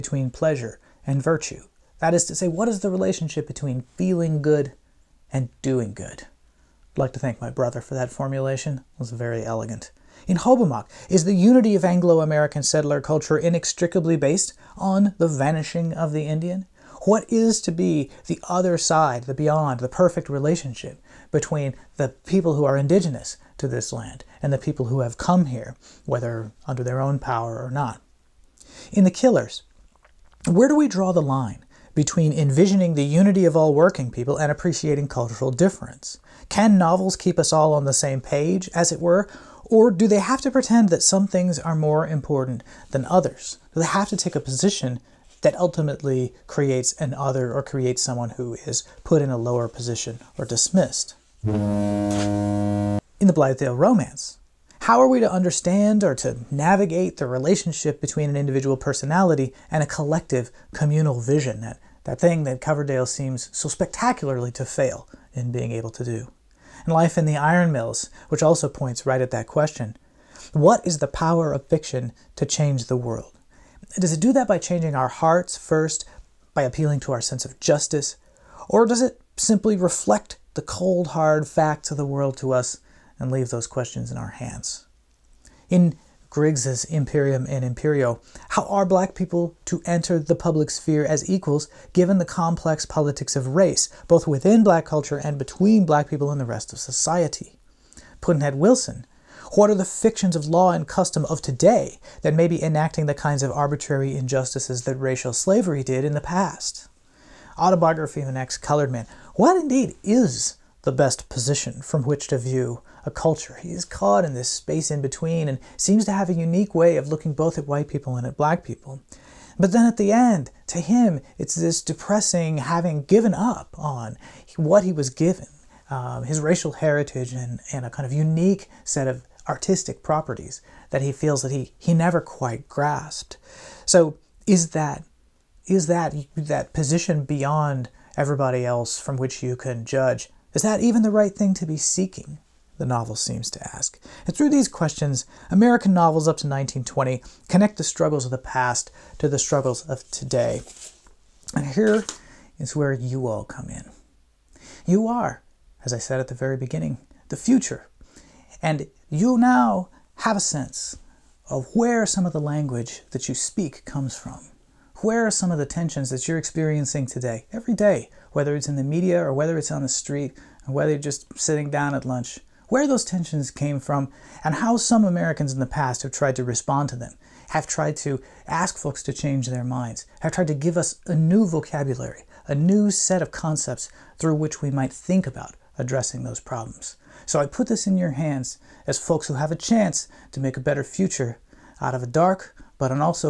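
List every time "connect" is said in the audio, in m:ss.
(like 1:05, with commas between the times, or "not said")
2:27.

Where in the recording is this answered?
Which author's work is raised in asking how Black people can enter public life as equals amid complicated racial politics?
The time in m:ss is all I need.
1:26.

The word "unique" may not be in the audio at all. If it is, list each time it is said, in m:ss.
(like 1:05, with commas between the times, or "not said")
1:56, 2:08.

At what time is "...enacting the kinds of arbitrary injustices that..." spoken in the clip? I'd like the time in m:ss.
1:42.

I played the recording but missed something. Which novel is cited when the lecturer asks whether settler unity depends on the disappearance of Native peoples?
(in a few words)
Hobomok.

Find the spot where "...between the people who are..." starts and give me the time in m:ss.
0:21.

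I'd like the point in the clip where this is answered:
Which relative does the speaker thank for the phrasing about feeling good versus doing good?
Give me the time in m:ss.
0:07.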